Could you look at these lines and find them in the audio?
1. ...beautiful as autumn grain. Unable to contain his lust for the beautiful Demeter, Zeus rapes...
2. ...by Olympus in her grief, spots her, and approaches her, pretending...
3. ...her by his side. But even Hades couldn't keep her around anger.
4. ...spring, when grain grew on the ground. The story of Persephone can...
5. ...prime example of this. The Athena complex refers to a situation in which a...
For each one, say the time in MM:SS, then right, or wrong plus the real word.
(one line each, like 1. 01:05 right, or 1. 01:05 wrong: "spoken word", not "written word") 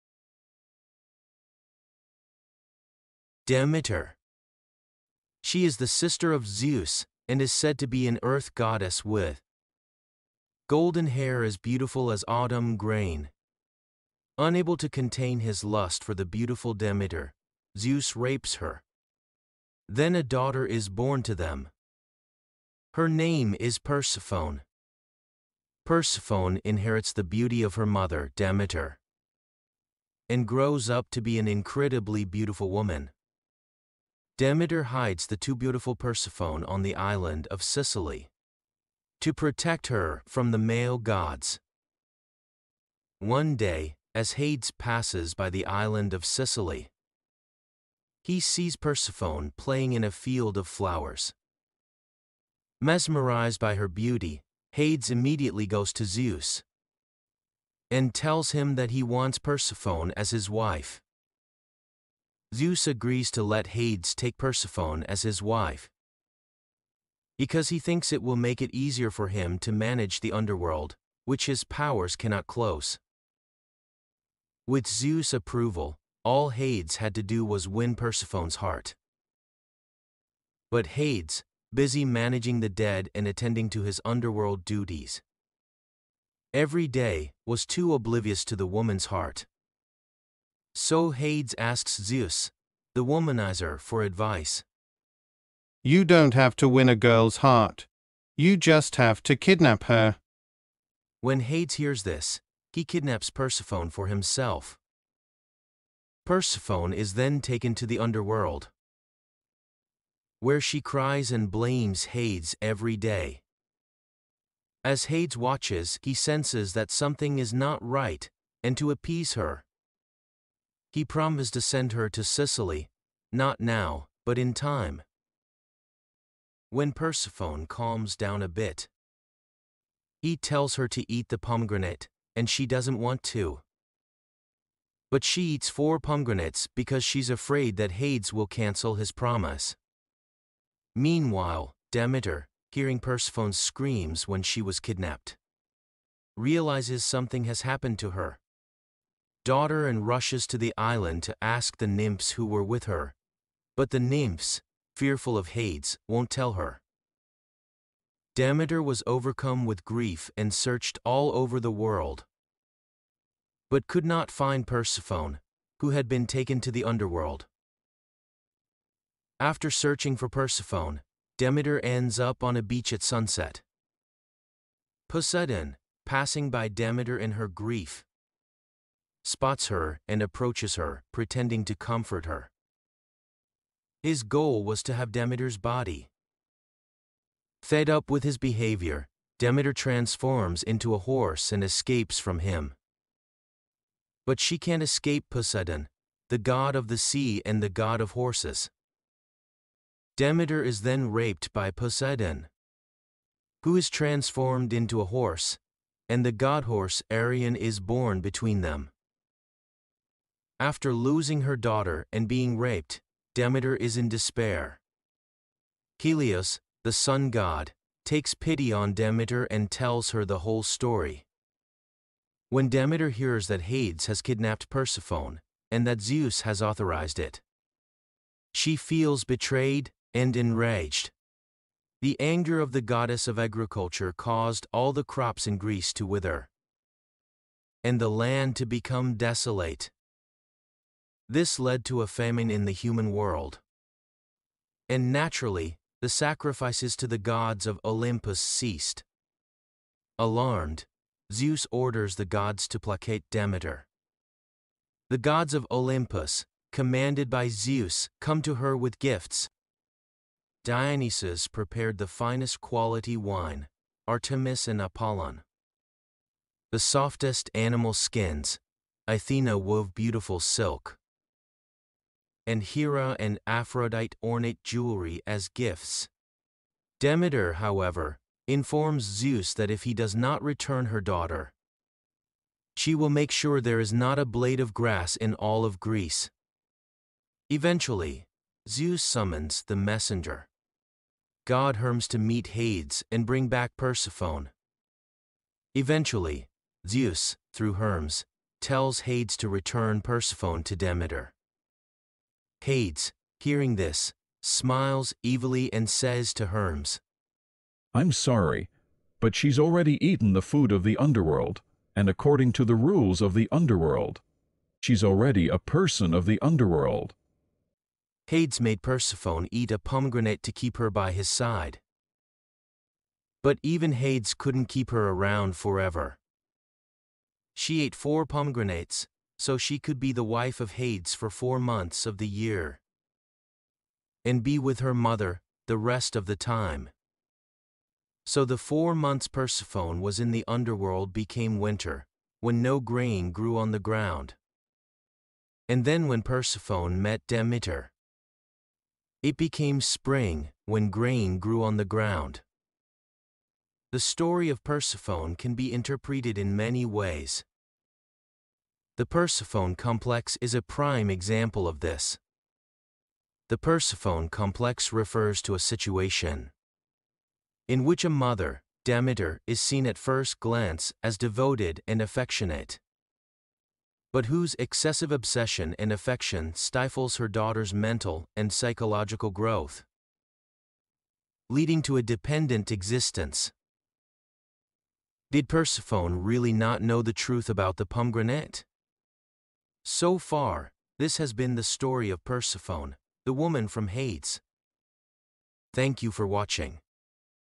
1. 00:11 right
2. 02:56 wrong: "Demeter", not "Olympus"
3. 05:20 wrong: "forever", not "anger"
4. 05:49 right
5. 06:00 wrong: "Persephone", not "Athena".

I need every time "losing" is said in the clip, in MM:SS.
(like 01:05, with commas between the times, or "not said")
03:30.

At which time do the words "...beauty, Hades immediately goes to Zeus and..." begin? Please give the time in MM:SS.
00:53.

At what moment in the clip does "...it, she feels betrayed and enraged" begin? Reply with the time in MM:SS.
03:47.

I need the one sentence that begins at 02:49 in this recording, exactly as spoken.
After searching for Persephone, Demeter ends up on a beach at sunset.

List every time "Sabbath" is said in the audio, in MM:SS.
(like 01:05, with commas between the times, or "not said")
not said.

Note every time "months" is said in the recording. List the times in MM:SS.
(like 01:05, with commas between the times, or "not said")
05:31, 05:38.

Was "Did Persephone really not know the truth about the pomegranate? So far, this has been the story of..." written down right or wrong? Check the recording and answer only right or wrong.
right.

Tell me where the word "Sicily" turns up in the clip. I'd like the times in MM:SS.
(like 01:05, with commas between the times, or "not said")
00:37, 00:46, 02:02.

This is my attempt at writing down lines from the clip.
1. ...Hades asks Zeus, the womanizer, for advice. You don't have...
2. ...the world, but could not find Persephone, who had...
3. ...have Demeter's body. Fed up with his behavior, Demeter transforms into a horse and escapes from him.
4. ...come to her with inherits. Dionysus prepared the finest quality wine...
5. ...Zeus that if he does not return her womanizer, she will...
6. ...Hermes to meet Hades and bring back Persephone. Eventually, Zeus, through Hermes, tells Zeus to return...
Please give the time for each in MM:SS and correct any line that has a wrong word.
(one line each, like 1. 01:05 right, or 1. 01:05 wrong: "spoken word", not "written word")
1. 01:31 right
2. 02:41 right
3. 03:04 right
4. 04:18 wrong: "gifts", not "inherits"
5. 04:39 wrong: "daughter", not "womanizer"
6. 04:51 wrong: "Hades", not "Zeus".